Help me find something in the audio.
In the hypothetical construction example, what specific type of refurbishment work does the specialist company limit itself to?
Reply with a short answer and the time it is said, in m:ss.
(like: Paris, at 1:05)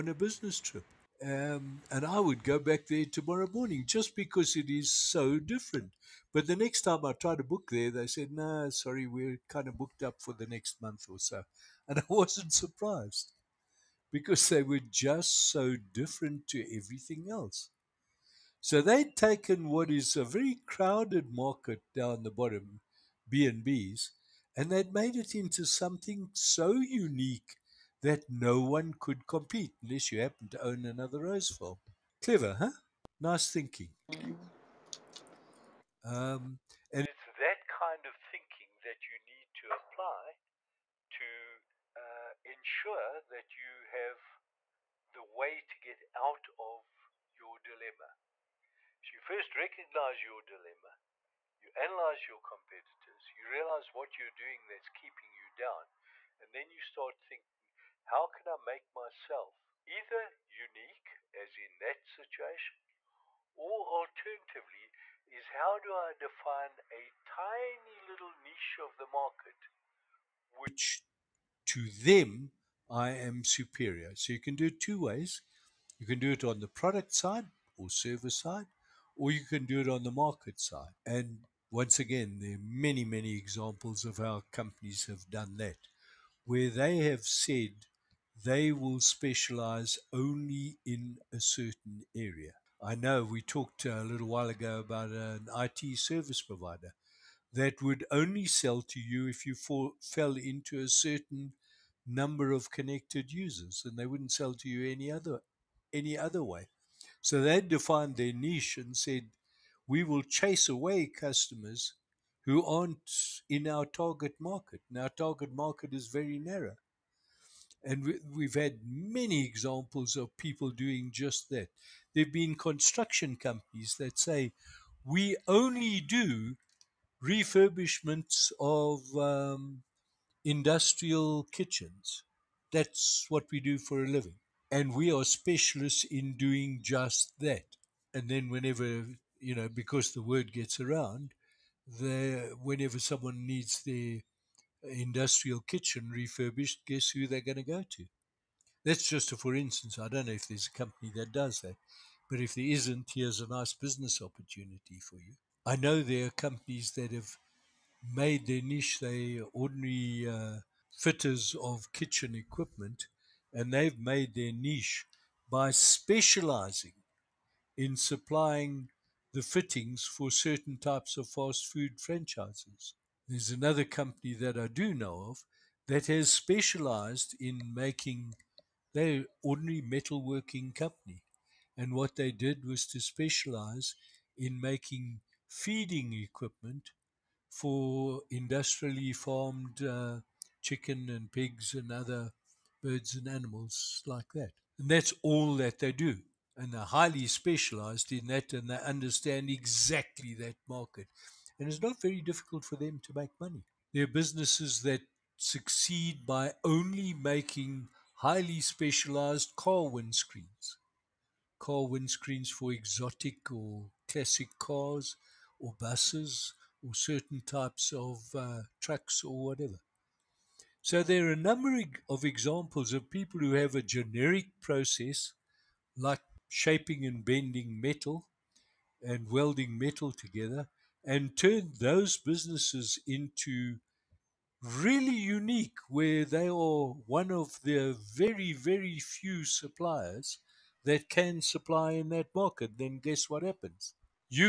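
industrial kitchens, at 2:10.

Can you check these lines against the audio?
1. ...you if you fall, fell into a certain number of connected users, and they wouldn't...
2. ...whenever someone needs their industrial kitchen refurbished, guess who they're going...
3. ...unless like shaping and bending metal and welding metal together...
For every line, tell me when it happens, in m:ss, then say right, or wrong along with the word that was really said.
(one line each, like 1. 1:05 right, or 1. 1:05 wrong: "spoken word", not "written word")
1. 1:38 right
2. 2:22 right
3. 3:44 wrong: "process", not "unless".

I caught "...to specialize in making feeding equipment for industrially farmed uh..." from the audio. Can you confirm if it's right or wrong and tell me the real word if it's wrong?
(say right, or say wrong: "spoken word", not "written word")
right.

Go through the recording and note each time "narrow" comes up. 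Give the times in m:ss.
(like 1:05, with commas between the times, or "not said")
1:56.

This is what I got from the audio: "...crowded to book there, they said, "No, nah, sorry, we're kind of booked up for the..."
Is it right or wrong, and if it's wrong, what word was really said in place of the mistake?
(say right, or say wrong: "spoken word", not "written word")
wrong: "tried", not "crowded".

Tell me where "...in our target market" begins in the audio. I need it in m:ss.
1:53.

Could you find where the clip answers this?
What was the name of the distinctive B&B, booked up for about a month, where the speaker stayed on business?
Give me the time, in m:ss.
0:31.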